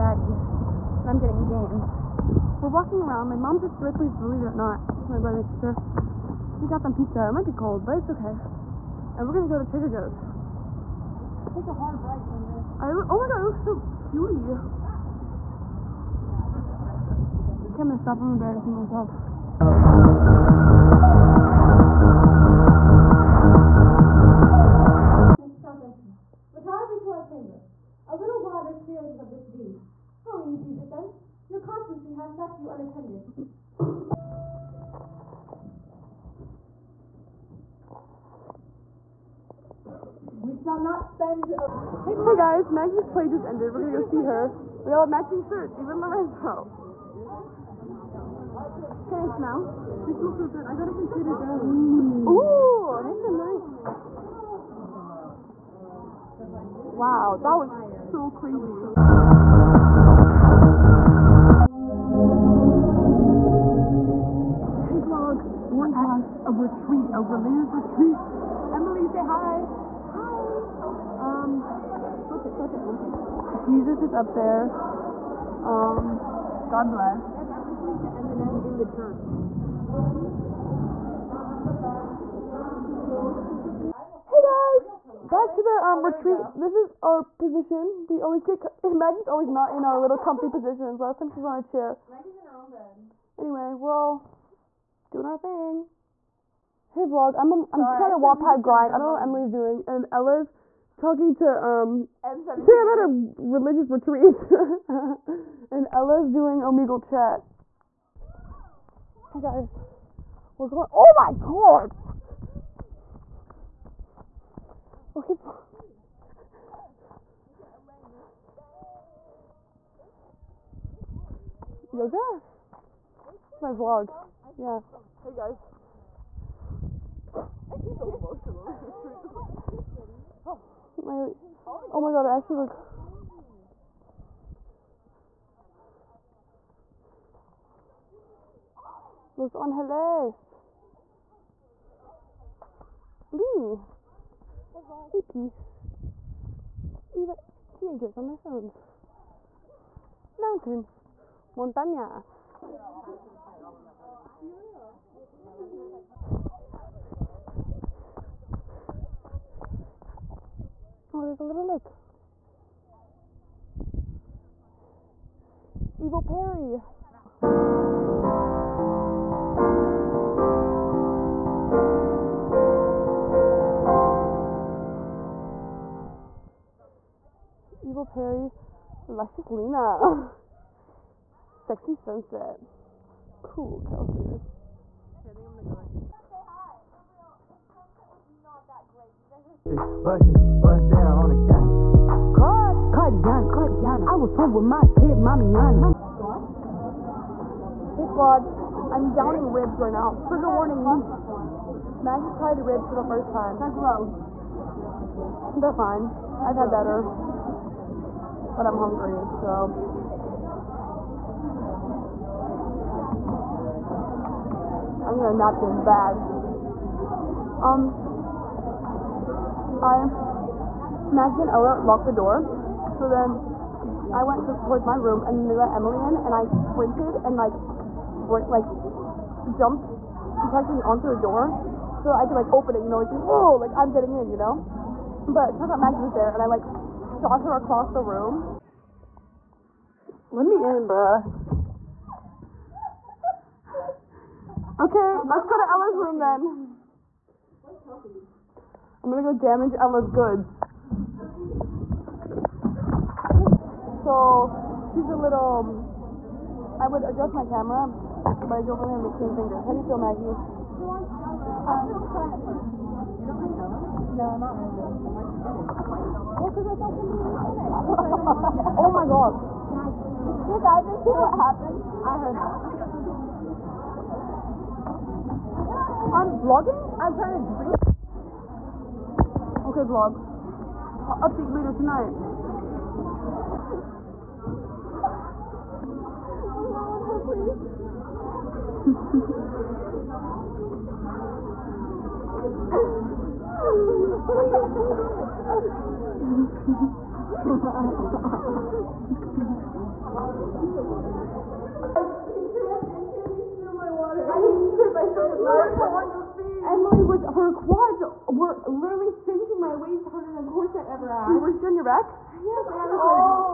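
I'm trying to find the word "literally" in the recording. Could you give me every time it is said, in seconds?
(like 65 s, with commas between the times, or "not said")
308 s.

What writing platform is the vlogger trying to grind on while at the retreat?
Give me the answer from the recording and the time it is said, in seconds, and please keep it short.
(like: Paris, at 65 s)
Wattpad, at 98 s.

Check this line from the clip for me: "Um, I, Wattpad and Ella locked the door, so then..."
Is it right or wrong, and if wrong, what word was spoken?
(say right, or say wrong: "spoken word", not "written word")
wrong: "Maggie", not "Wattpad".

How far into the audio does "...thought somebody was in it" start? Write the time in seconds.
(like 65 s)
266 s.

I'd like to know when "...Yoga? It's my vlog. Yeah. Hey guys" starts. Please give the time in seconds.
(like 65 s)
121 s.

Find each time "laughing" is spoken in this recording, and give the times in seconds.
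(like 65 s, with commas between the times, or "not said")
305 s.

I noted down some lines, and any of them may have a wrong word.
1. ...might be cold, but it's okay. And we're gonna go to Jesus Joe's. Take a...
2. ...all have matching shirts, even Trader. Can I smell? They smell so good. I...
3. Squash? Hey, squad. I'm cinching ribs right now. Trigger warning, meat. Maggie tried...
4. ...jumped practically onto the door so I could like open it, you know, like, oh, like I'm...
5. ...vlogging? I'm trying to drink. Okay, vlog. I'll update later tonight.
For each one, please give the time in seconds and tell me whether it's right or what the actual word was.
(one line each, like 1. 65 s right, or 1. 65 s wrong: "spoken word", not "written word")
1. 7 s wrong: "Trader", not "Jesus"
2. 44 s wrong: "Lorenzo", not "Trader"
3. 196 s wrong: "downing", not "cinching"
4. 229 s right
5. 276 s right.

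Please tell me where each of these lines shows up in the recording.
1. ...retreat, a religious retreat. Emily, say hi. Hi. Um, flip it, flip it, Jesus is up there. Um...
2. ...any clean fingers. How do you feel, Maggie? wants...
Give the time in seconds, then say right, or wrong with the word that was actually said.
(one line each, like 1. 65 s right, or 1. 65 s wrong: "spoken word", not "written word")
1. 66 s right
2. 259 s right.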